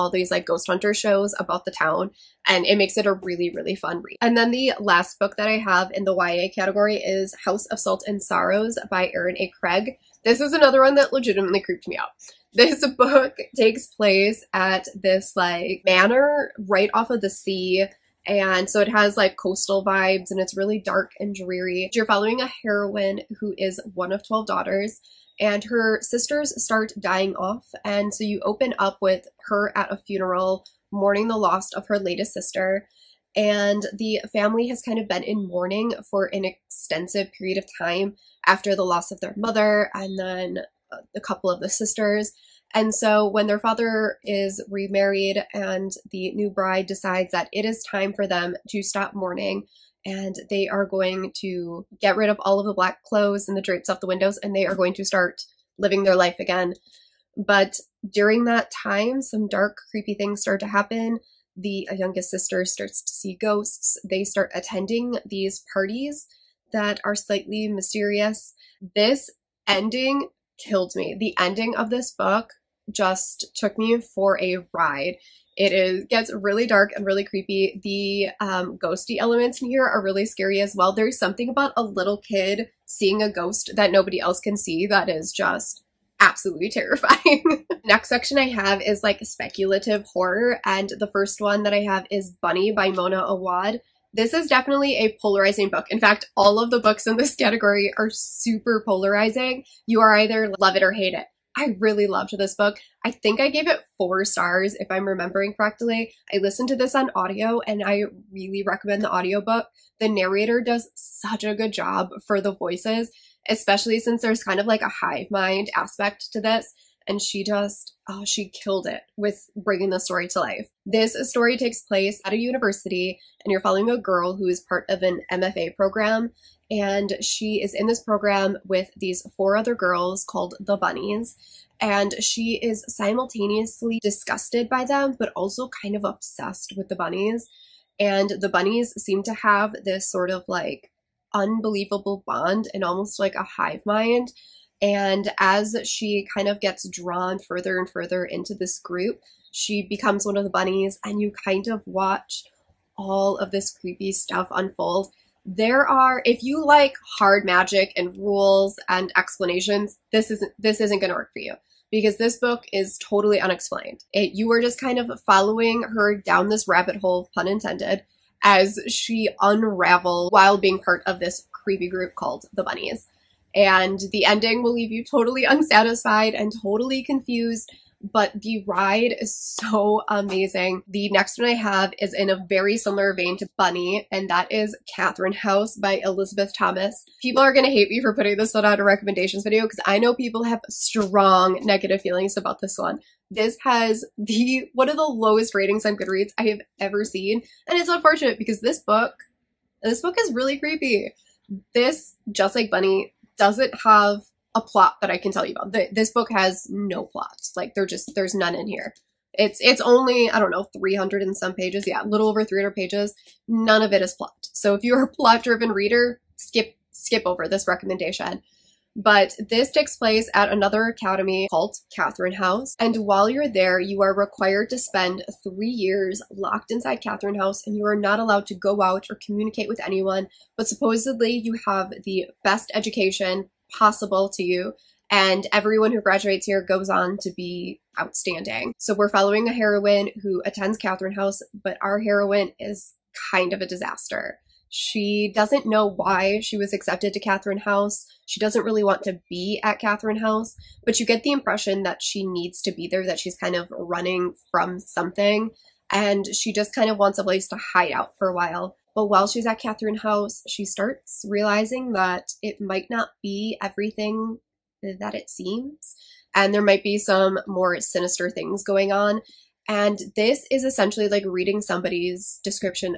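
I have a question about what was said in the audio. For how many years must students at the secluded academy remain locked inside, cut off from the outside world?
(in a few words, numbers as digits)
3.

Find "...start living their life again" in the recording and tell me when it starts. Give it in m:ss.
0:55.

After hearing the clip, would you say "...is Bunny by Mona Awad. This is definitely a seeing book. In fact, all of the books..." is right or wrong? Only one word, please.
wrong.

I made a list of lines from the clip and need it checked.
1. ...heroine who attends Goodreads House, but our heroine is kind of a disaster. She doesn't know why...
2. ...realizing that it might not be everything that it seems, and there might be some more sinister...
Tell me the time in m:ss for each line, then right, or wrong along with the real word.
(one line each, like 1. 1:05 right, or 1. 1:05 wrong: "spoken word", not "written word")
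1. 3:59 wrong: "Catherine", not "Goodreads"
2. 4:21 right.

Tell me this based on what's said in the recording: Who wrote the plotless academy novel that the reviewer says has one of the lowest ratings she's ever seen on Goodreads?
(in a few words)
Elisabeth Thomas.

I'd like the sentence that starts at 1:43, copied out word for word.
I think I gave it four stars if I'm remembering correctly.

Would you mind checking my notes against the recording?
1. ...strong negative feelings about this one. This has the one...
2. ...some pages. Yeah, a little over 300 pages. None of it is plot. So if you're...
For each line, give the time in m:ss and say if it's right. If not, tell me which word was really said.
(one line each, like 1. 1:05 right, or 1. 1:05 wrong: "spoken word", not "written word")
1. 3:10 right
2. 3:31 right.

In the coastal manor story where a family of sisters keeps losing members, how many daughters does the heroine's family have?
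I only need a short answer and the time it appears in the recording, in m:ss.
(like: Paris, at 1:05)
12, at 0:24.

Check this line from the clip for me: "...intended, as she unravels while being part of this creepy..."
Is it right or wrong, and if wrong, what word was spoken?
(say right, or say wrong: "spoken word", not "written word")
right.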